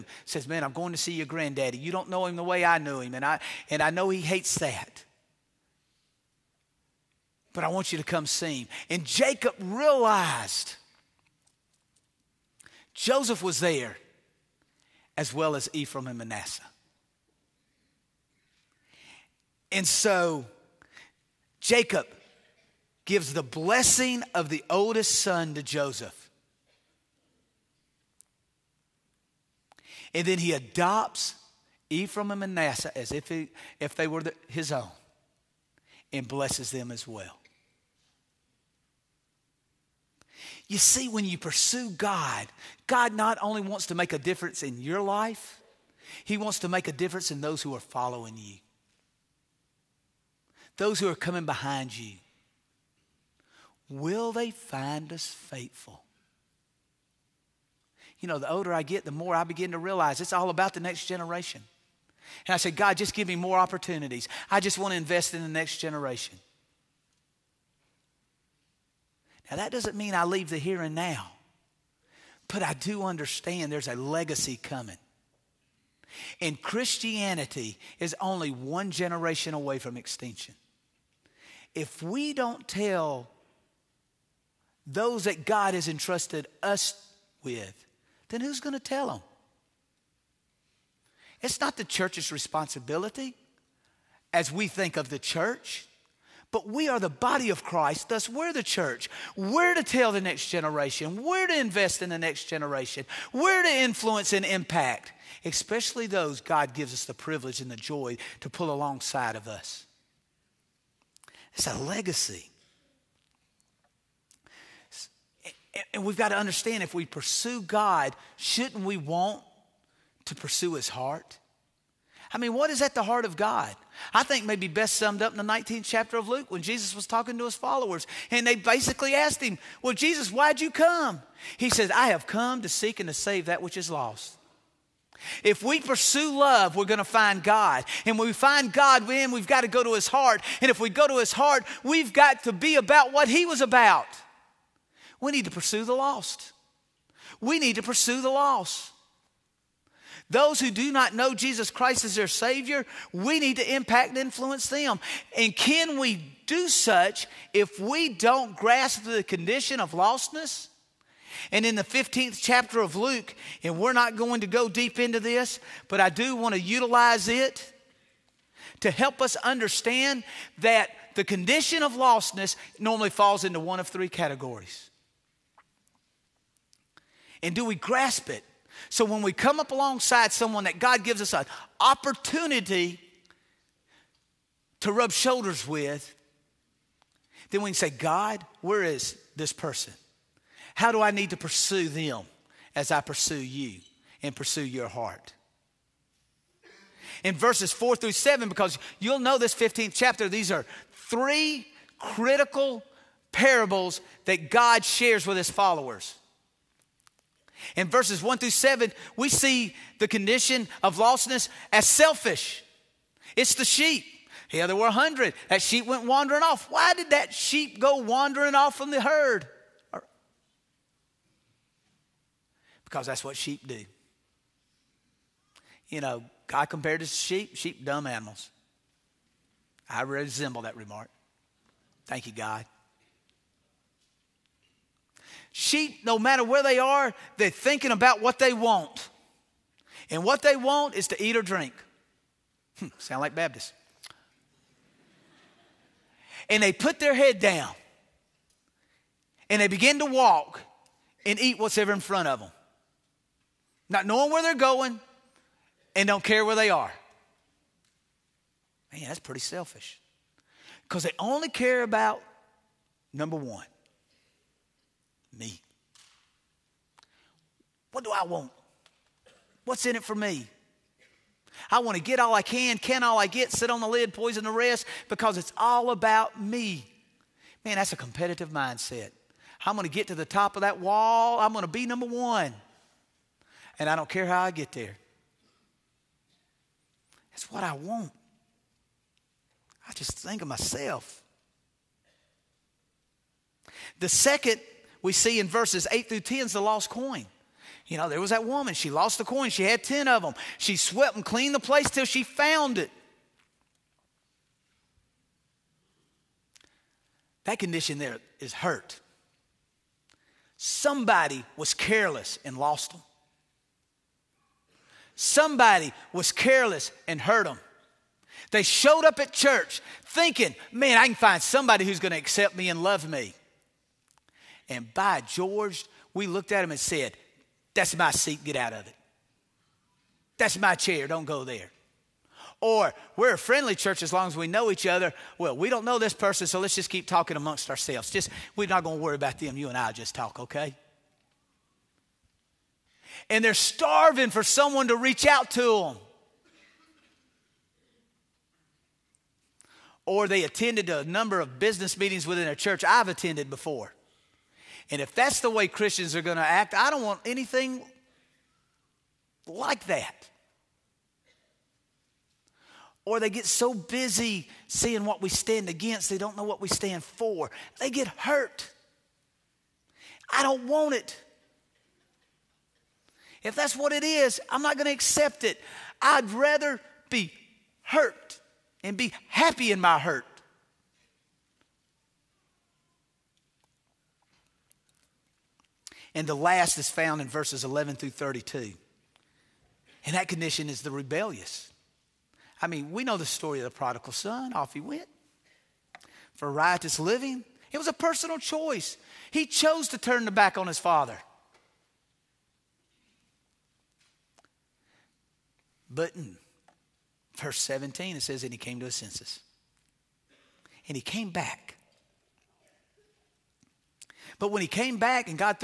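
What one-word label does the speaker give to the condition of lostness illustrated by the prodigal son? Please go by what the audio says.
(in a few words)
Rebellious.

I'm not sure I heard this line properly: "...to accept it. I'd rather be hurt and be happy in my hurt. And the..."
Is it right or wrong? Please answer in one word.
right.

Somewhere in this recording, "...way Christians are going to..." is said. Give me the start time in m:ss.
5:55.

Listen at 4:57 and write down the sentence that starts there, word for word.
You know, there was that woman.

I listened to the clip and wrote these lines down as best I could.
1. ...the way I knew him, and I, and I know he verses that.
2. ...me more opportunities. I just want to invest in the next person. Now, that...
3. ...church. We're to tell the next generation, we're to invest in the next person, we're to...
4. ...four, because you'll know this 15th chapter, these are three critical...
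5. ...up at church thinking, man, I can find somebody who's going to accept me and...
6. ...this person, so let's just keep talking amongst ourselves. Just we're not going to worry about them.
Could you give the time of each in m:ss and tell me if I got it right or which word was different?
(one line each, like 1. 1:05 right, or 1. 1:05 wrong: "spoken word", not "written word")
1. 0:02 wrong: "hates", not "verses"
2. 1:03 wrong: "generation", not "person"
3. 1:38 wrong: "generation", not "person"
4. 3:18 wrong: "seven", not "four"
5. 5:19 right
6. 5:35 right.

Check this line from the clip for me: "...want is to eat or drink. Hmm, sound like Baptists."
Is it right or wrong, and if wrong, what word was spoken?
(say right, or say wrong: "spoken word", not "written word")
right.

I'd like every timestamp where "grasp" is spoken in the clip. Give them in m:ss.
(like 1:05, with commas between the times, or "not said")
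2:38, 2:57.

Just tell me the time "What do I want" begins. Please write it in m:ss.
4:27.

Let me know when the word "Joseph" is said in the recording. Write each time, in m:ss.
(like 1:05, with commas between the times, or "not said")
0:12, 0:25.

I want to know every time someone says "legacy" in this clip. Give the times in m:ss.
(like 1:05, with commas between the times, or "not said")
1:13, 1:51.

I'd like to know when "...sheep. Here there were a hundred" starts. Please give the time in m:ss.
3:33.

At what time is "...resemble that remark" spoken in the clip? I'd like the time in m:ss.
3:50.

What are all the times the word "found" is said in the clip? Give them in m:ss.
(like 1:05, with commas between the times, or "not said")
5:02, 6:26.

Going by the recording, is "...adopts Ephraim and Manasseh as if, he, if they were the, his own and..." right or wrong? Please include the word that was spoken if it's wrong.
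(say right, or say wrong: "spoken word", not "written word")
right.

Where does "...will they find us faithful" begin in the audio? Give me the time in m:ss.
0:53.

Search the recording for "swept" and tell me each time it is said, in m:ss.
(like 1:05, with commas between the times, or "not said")
5:00.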